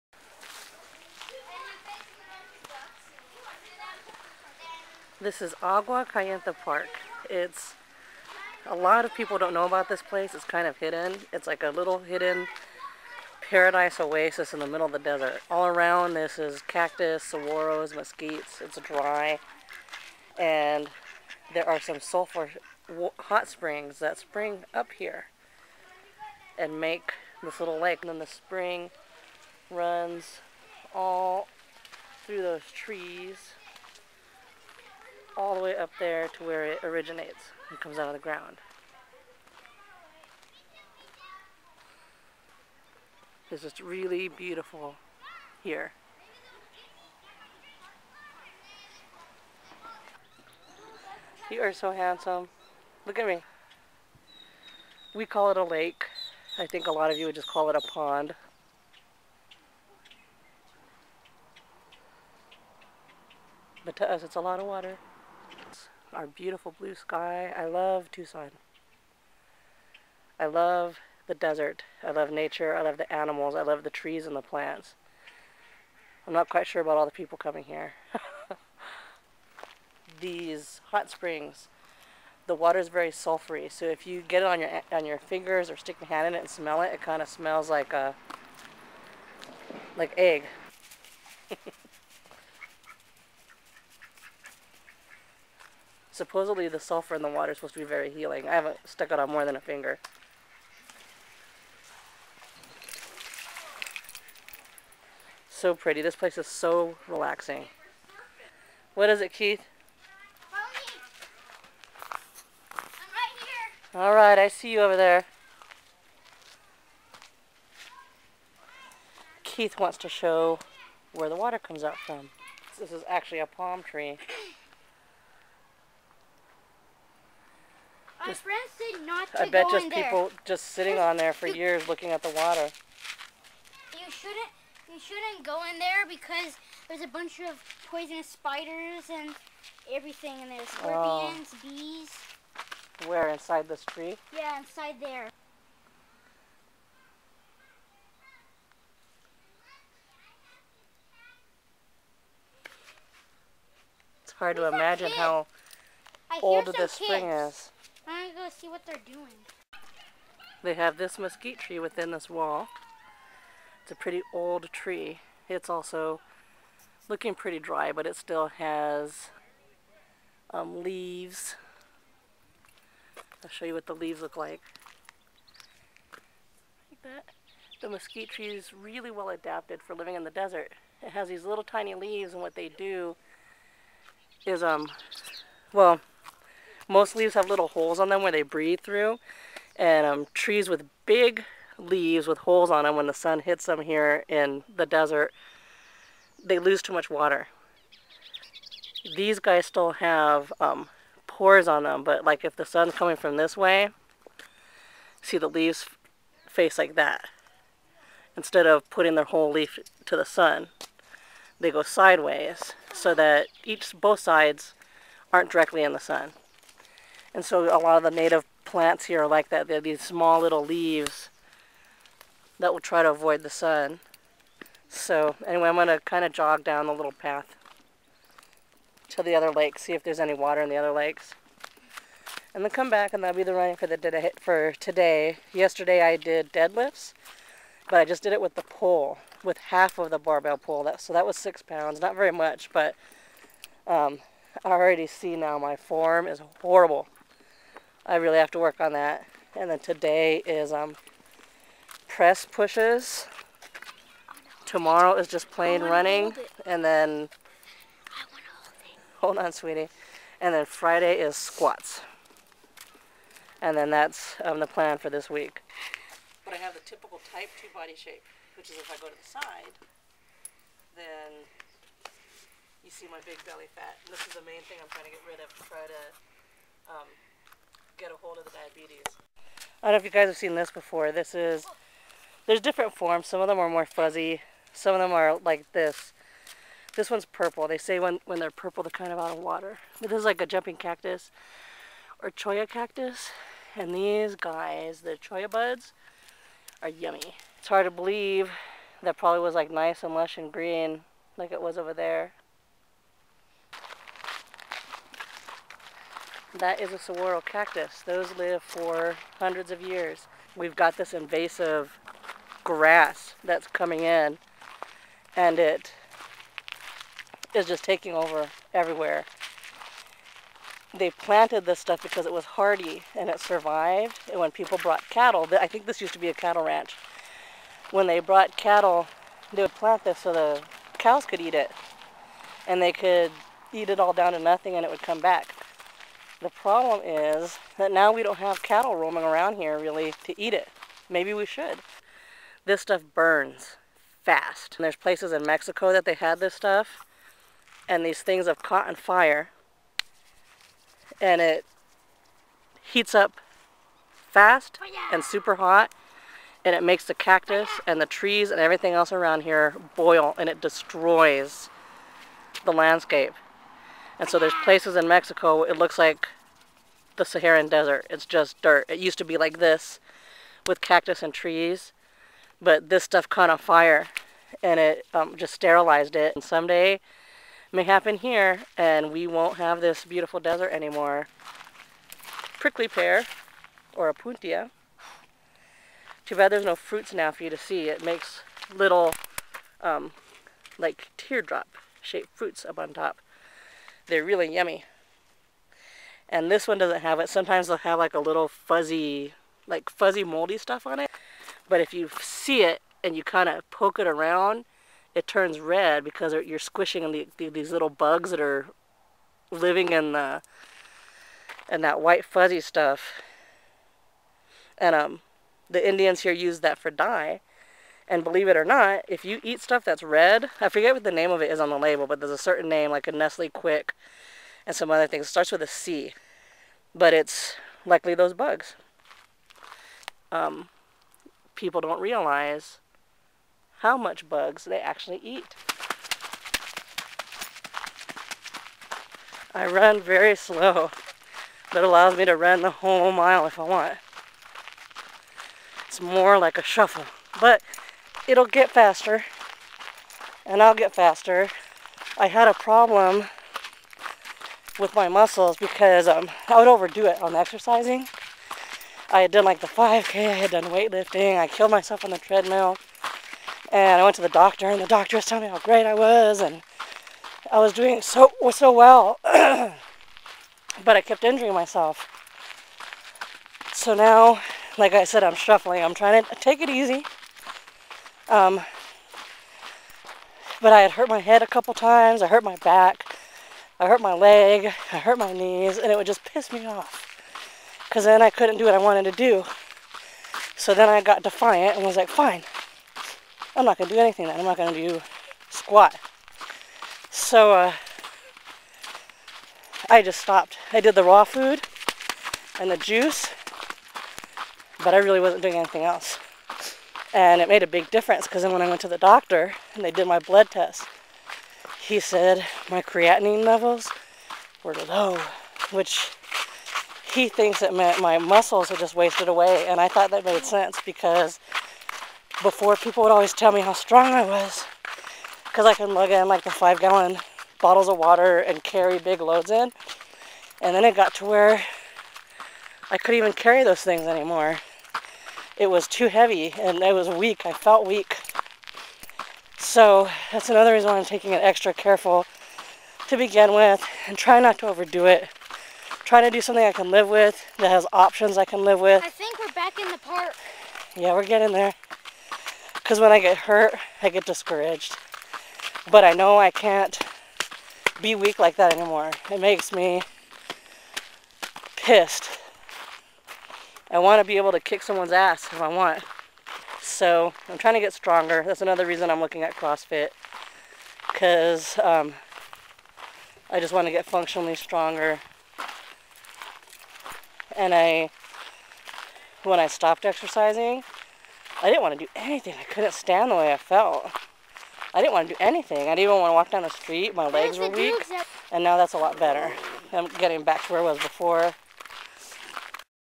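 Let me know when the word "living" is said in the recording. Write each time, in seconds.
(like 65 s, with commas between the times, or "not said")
179 s, 409 s.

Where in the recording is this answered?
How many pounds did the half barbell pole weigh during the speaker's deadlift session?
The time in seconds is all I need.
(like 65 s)
241 s.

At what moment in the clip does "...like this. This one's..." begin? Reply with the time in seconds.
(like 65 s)
285 s.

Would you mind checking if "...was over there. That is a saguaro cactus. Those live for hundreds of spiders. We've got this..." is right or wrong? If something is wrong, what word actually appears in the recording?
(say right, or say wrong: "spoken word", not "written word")
wrong: "years", not "spiders".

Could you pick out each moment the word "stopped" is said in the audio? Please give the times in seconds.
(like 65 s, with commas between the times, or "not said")
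500 s, 579 s.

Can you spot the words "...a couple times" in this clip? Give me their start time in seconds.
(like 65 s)
481 s.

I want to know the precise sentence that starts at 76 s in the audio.
I'm not quite sure about all the people coming here.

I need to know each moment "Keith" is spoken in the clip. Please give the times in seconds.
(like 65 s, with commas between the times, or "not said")
109 s, 119 s.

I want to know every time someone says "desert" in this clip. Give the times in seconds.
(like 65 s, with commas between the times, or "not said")
14 s, 71 s, 180 s, 194 s, 367 s, 380 s.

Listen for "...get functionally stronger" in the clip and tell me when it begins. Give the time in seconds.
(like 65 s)
573 s.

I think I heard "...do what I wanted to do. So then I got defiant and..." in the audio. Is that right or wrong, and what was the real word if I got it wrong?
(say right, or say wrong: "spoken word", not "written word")
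right.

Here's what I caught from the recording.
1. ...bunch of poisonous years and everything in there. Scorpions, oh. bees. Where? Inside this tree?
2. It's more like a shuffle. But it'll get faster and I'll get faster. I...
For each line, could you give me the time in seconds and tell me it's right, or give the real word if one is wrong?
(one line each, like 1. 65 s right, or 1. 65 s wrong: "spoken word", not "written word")
1. 137 s wrong: "spiders", not "years"
2. 445 s right.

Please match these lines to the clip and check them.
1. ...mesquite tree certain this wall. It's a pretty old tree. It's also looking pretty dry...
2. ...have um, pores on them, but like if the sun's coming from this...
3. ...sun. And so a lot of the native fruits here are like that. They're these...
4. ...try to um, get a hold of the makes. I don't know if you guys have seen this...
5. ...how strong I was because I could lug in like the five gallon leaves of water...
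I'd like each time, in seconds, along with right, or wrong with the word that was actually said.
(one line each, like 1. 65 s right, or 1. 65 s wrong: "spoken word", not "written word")
1. 161 s wrong: "within", not "certain"
2. 199 s right
3. 215 s wrong: "plants", not "fruits"
4. 275 s wrong: "diabetes", not "makes"
5. 523 s wrong: "bottles", not "leaves".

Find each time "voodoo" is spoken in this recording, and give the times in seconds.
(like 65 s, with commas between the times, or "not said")
not said.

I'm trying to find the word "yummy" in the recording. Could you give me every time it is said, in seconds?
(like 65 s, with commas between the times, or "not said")
296 s, 394 s.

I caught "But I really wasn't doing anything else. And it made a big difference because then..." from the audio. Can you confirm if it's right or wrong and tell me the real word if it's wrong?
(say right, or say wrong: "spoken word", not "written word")
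right.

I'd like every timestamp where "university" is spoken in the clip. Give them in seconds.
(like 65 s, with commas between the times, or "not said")
not said.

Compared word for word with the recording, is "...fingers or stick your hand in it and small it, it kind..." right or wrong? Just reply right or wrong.
wrong.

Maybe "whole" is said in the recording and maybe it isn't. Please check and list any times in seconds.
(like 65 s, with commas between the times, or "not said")
209 s, 442 s.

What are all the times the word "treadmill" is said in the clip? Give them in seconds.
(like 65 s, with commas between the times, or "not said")
462 s.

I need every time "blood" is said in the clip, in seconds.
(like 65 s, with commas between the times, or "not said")
510 s.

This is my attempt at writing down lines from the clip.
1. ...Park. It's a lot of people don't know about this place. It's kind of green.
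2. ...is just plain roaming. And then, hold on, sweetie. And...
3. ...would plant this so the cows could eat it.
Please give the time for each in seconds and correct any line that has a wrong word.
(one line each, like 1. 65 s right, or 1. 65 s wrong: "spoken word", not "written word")
1. 6 s wrong: "hidden", not "green"
2. 255 s wrong: "running", not "roaming"
3. 329 s right.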